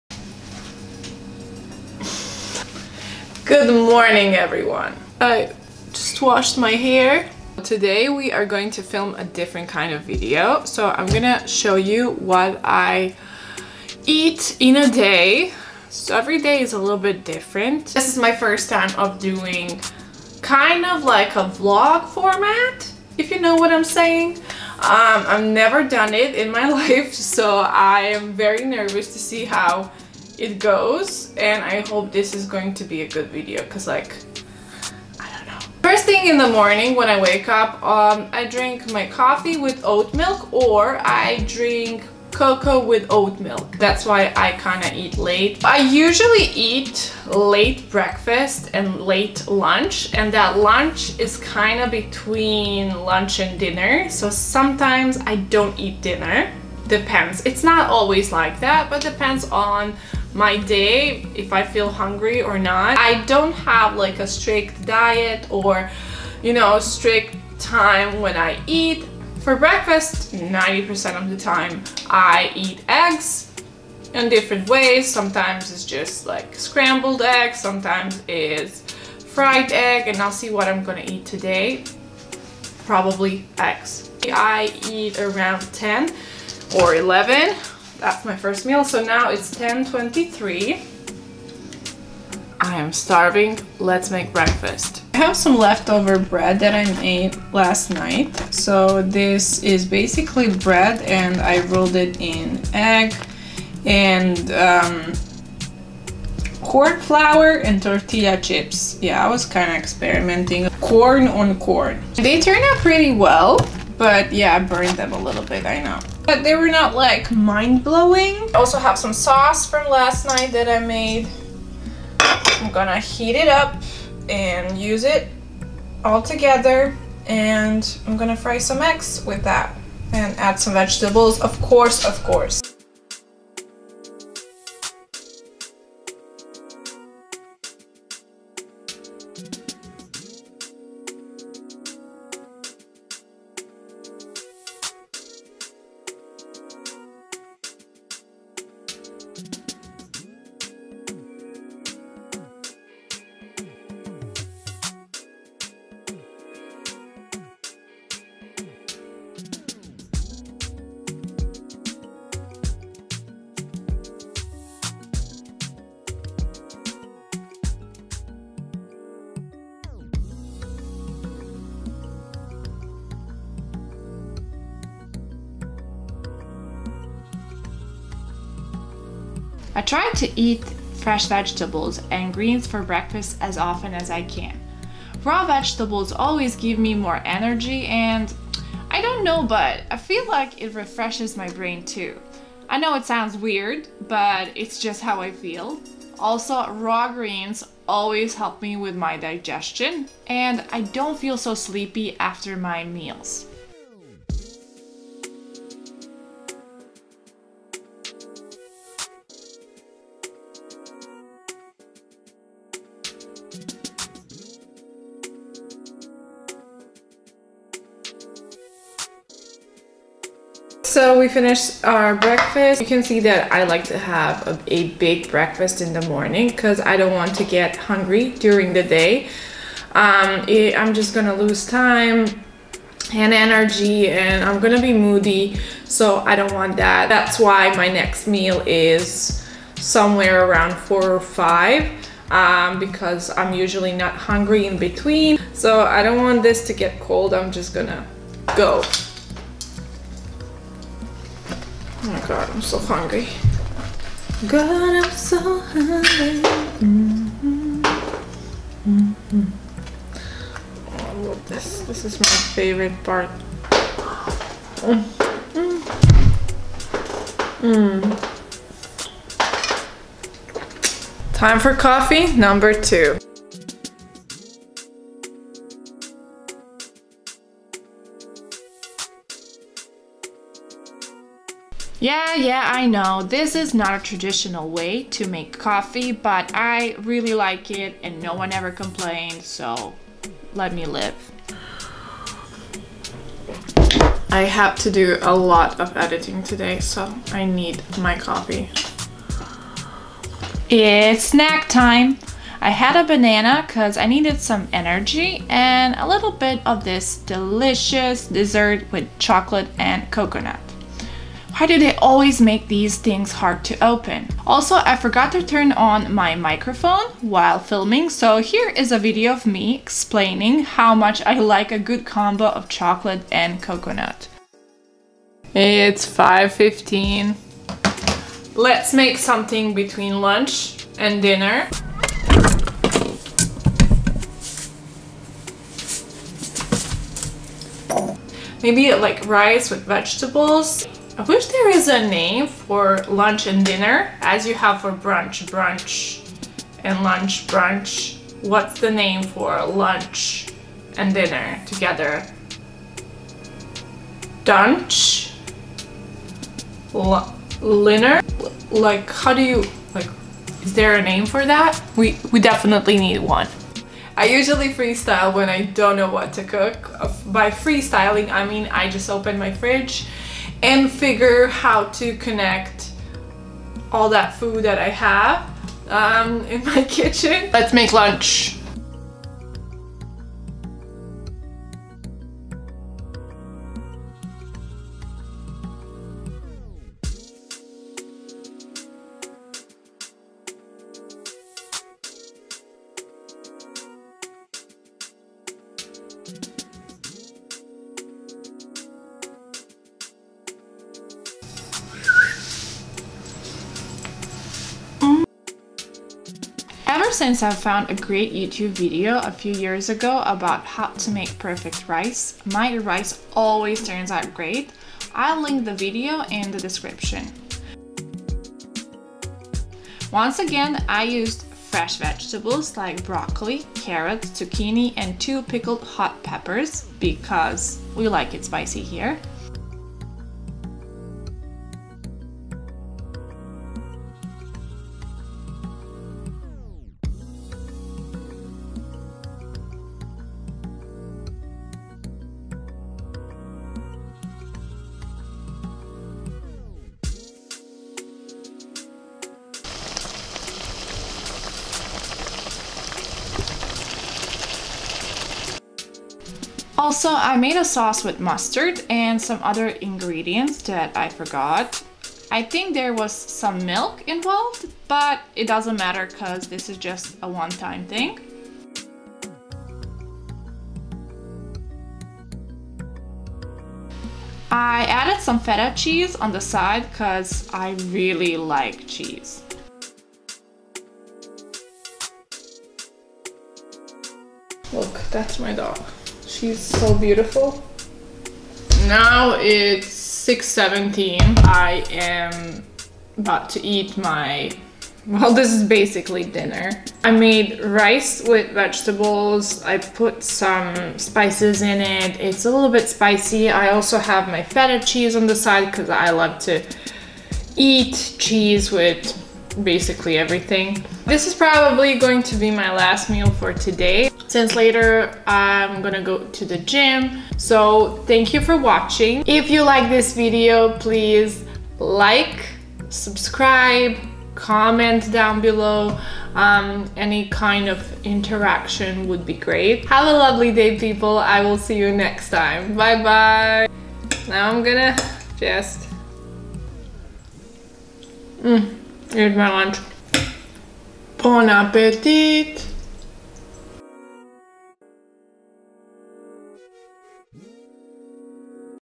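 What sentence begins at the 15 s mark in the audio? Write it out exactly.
So every day is a little bit different.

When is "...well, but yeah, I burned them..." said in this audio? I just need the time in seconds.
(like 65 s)
113 s.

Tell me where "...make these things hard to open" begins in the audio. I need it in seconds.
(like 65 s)
312 s.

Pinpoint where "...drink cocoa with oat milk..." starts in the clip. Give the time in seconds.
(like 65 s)
41 s.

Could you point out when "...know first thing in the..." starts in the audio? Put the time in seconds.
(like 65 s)
35 s.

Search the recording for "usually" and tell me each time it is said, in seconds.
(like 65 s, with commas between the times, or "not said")
45 s, 243 s, 364 s.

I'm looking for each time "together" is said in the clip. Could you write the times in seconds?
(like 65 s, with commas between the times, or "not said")
126 s, 351 s.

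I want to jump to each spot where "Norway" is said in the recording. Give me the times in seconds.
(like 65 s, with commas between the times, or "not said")
not said.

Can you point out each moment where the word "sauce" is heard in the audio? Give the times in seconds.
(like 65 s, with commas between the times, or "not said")
119 s, 457 s.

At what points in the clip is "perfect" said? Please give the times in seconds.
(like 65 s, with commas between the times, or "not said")
411 s.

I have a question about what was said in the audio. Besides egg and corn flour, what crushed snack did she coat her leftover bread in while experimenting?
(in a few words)
Tortilla chips.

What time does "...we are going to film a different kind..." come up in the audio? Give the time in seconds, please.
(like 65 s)
8 s.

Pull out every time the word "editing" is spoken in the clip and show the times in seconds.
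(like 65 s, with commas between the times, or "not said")
295 s.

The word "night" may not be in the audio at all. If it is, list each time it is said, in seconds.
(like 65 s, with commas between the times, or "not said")
97 s, 120 s.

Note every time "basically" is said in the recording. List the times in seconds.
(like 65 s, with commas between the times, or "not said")
99 s, 495 s, 509 s.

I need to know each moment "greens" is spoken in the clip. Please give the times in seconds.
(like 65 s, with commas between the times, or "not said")
182 s, 197 s.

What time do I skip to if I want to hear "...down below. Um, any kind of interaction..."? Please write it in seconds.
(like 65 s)
525 s.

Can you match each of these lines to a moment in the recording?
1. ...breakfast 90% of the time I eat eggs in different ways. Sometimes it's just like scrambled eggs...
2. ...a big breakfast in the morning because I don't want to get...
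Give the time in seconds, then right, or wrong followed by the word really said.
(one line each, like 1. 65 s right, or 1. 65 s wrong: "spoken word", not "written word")
1. 69 s right
2. 224 s right.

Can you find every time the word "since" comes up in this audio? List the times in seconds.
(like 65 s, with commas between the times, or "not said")
407 s, 514 s.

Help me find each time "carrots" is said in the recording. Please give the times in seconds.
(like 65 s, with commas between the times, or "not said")
423 s.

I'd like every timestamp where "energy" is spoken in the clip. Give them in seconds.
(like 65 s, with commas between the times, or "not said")
187 s, 233 s, 304 s.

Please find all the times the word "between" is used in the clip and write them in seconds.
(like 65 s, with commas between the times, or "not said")
51 s, 244 s, 329 s.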